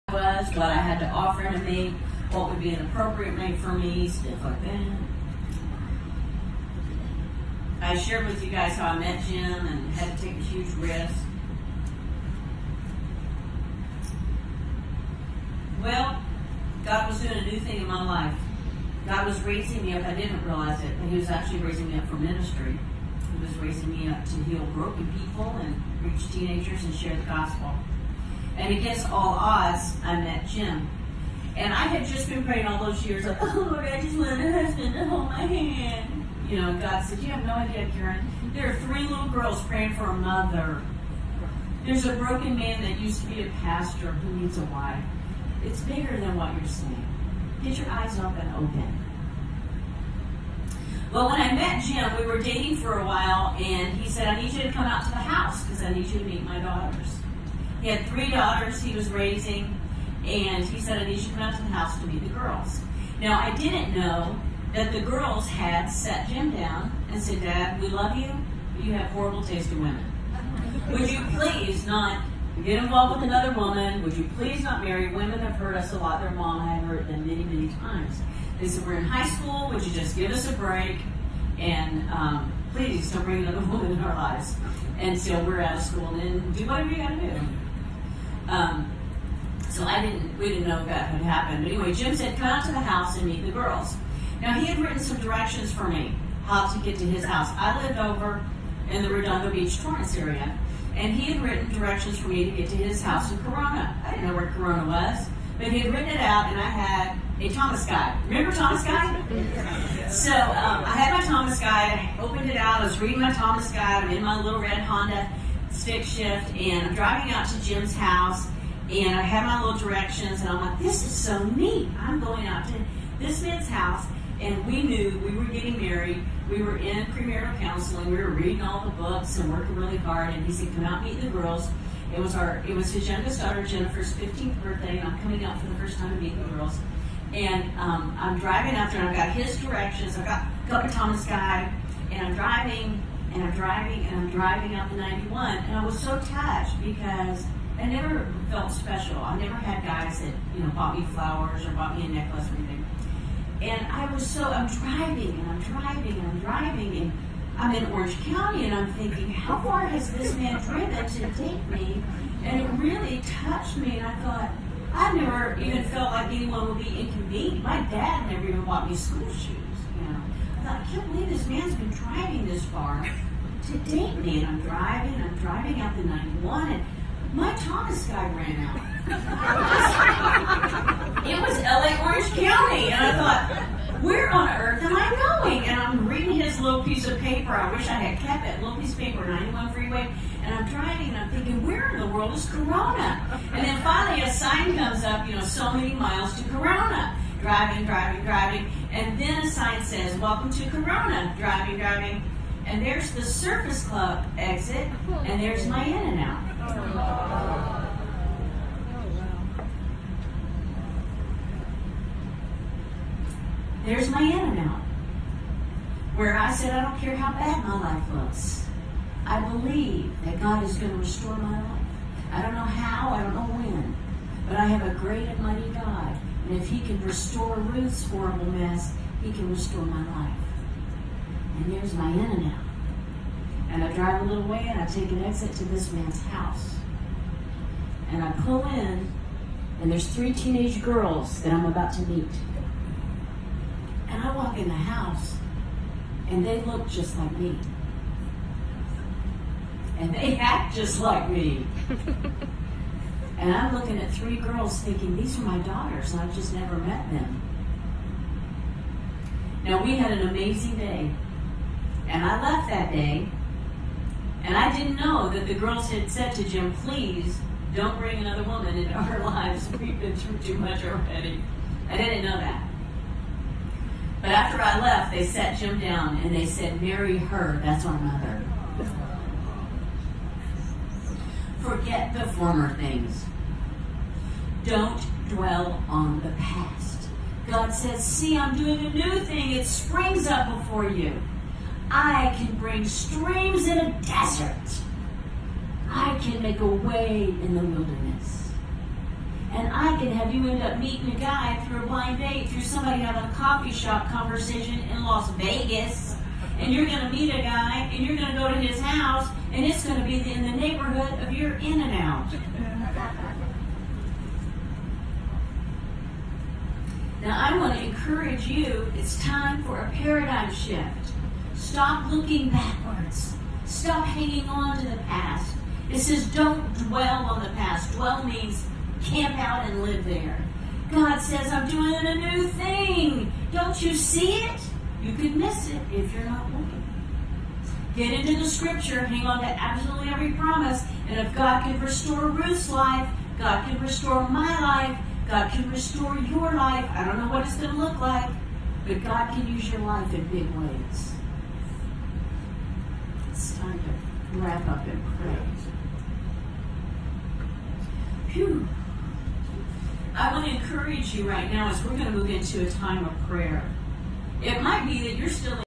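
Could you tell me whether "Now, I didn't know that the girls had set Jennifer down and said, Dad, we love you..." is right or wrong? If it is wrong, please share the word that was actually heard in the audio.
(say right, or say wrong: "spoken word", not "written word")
wrong: "Jim", not "Jennifer".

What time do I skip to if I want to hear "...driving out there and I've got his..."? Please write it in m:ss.
2:18.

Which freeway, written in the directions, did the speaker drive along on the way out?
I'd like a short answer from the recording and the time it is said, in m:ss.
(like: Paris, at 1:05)
91, at 2:24.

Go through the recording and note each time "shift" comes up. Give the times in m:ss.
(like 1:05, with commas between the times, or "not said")
1:56, 5:20.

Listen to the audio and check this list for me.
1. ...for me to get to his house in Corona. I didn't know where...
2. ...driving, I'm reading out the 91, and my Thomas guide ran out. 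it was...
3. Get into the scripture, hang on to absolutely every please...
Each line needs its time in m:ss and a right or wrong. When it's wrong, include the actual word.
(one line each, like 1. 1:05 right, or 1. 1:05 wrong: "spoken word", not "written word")
1. 1:42 right
2. 2:54 wrong: "driving", not "reading"
3. 5:37 wrong: "promise", not "please".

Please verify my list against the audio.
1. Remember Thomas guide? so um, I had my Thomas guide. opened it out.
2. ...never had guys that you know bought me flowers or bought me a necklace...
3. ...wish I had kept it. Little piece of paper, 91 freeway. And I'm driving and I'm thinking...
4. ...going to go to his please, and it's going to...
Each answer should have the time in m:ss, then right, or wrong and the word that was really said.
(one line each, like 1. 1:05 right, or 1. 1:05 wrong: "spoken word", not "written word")
1. 1:48 right
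2. 2:29 right
3. 3:07 right
4. 5:08 wrong: "house", not "please".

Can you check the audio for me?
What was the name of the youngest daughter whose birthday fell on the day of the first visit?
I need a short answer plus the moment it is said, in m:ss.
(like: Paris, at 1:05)
Jennifer, at 2:13.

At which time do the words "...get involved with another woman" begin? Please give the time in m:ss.
1:12.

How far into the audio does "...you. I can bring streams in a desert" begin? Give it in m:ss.
4:50.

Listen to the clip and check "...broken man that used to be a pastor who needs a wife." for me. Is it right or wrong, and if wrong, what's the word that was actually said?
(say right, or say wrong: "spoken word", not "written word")
right.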